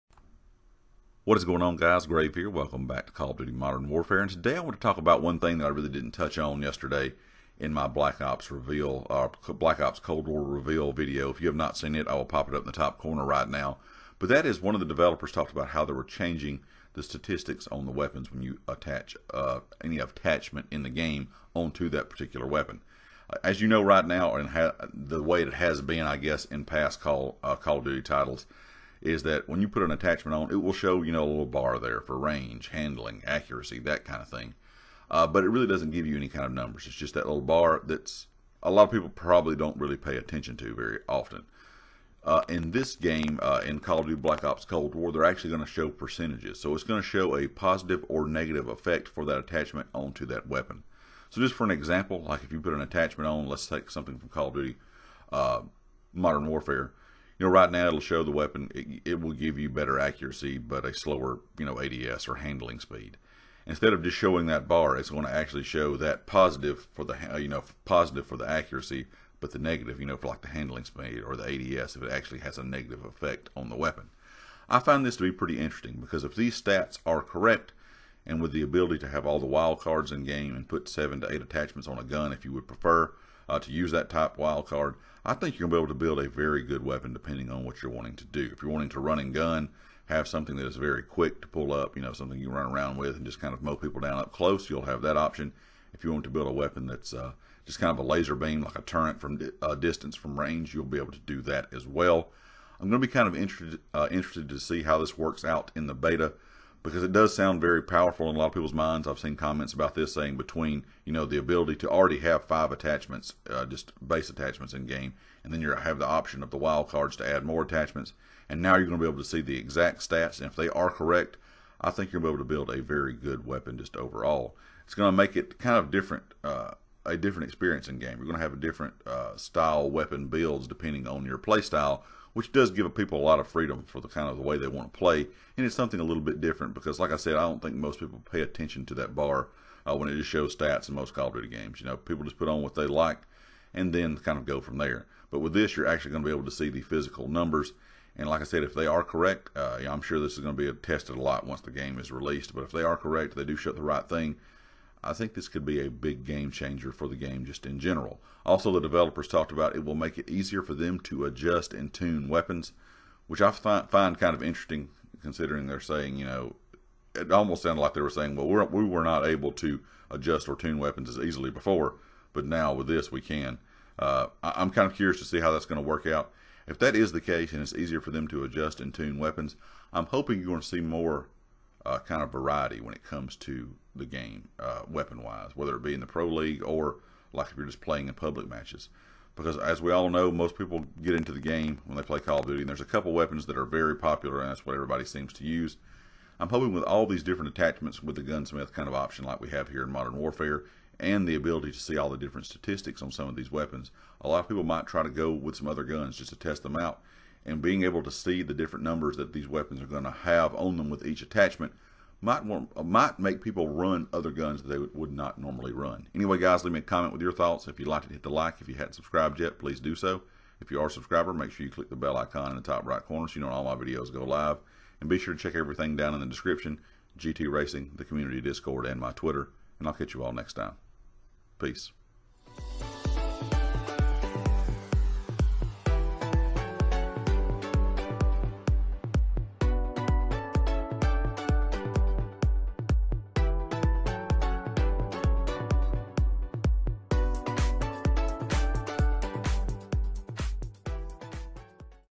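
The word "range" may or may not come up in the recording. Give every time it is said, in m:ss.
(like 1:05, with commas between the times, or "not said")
0:32, 1:40.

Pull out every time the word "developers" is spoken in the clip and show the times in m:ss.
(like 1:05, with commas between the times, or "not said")
0:14, 2:38.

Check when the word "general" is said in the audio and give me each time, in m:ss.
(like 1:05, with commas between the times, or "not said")
2:37.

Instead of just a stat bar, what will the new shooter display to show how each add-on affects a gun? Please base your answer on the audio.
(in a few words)
percentages.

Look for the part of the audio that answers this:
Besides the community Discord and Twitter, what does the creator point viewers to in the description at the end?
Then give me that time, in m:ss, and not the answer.
3:47.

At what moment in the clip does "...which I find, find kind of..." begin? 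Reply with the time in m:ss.
2:43.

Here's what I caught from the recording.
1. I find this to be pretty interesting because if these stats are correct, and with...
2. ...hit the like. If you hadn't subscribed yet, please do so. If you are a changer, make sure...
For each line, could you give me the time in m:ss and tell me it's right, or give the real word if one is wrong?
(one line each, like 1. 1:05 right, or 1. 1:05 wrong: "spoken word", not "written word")
1. 1:14 right
2. 3:38 wrong: "subscriber", not "changer".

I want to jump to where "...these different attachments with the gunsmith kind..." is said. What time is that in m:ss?
3:17.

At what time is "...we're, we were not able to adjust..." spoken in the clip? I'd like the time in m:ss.
2:48.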